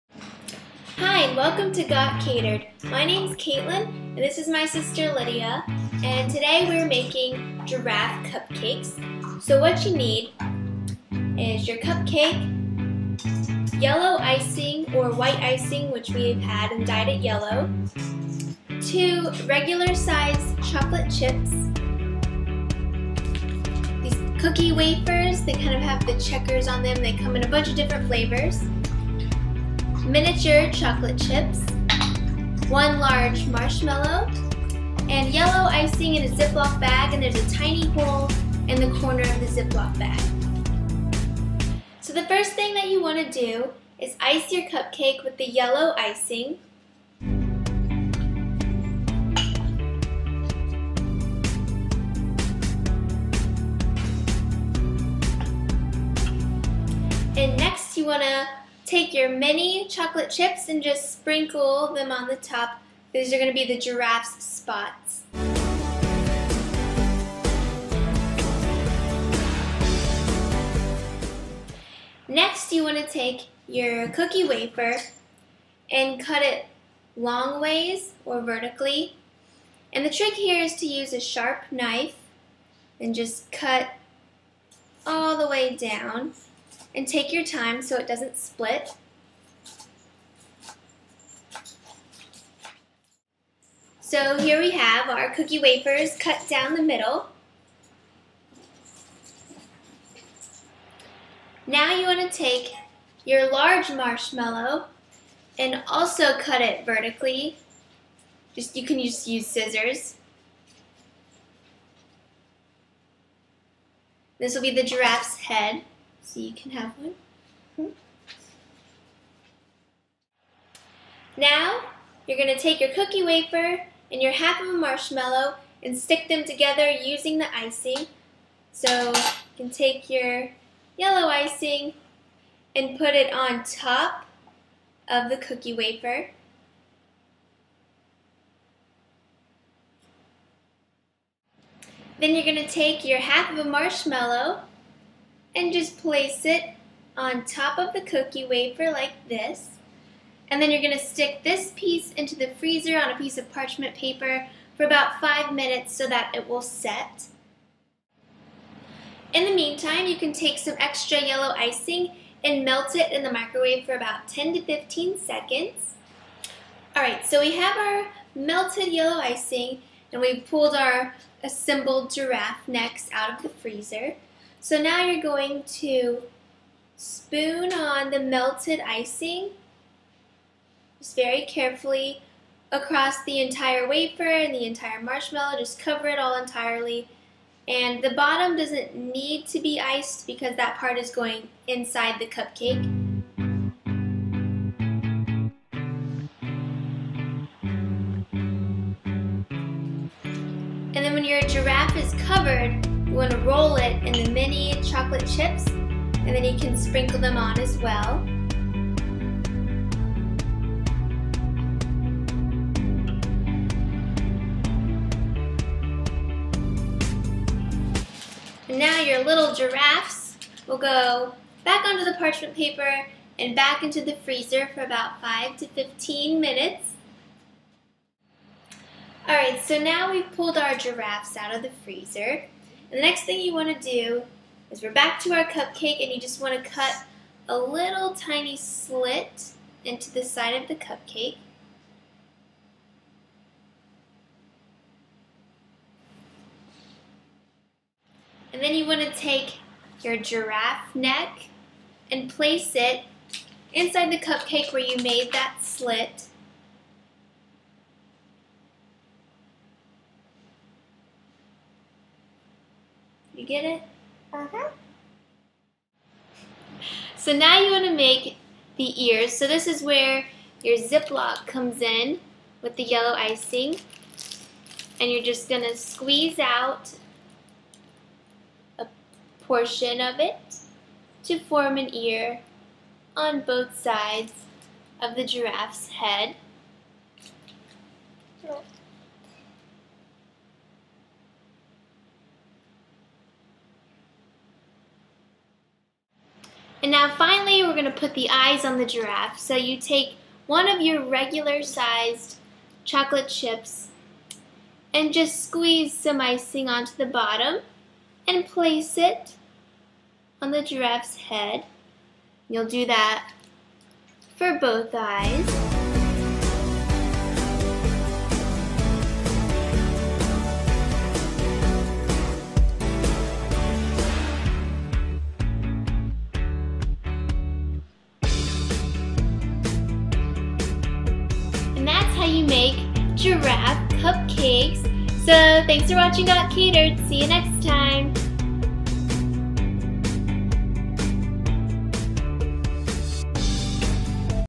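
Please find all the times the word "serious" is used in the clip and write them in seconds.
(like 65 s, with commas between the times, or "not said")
not said.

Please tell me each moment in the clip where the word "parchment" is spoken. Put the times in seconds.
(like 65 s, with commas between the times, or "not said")
153 s, 222 s.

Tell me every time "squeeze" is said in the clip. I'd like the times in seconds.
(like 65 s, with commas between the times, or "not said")
275 s, 305 s.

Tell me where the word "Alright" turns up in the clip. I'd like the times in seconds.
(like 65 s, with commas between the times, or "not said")
166 s, 229 s.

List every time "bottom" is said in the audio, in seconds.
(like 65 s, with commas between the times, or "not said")
188 s, 307 s.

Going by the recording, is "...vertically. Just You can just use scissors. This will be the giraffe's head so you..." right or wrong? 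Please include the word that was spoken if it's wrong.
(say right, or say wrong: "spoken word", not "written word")
right.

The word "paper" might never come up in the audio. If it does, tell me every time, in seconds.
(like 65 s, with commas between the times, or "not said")
153 s, 222 s.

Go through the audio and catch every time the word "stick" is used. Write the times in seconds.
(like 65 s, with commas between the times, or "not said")
125 s, 151 s.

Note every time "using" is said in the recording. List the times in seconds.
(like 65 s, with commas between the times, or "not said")
126 s.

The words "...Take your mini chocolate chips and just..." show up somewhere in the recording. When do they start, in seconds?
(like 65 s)
58 s.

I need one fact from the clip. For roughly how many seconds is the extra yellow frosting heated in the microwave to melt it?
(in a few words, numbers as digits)
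10 to 15.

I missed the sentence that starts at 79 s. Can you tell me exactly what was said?
And the trick here is to use a sharp knife and just cut all the way down.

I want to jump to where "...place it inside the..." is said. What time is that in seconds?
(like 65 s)
252 s.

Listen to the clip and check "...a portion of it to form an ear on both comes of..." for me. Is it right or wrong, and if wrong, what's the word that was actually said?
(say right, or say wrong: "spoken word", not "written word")
wrong: "sides", not "comes".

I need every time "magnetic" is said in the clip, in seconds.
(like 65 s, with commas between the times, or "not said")
not said.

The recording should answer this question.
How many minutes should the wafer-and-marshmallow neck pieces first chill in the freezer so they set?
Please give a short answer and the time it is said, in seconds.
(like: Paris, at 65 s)
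5, at 155 s.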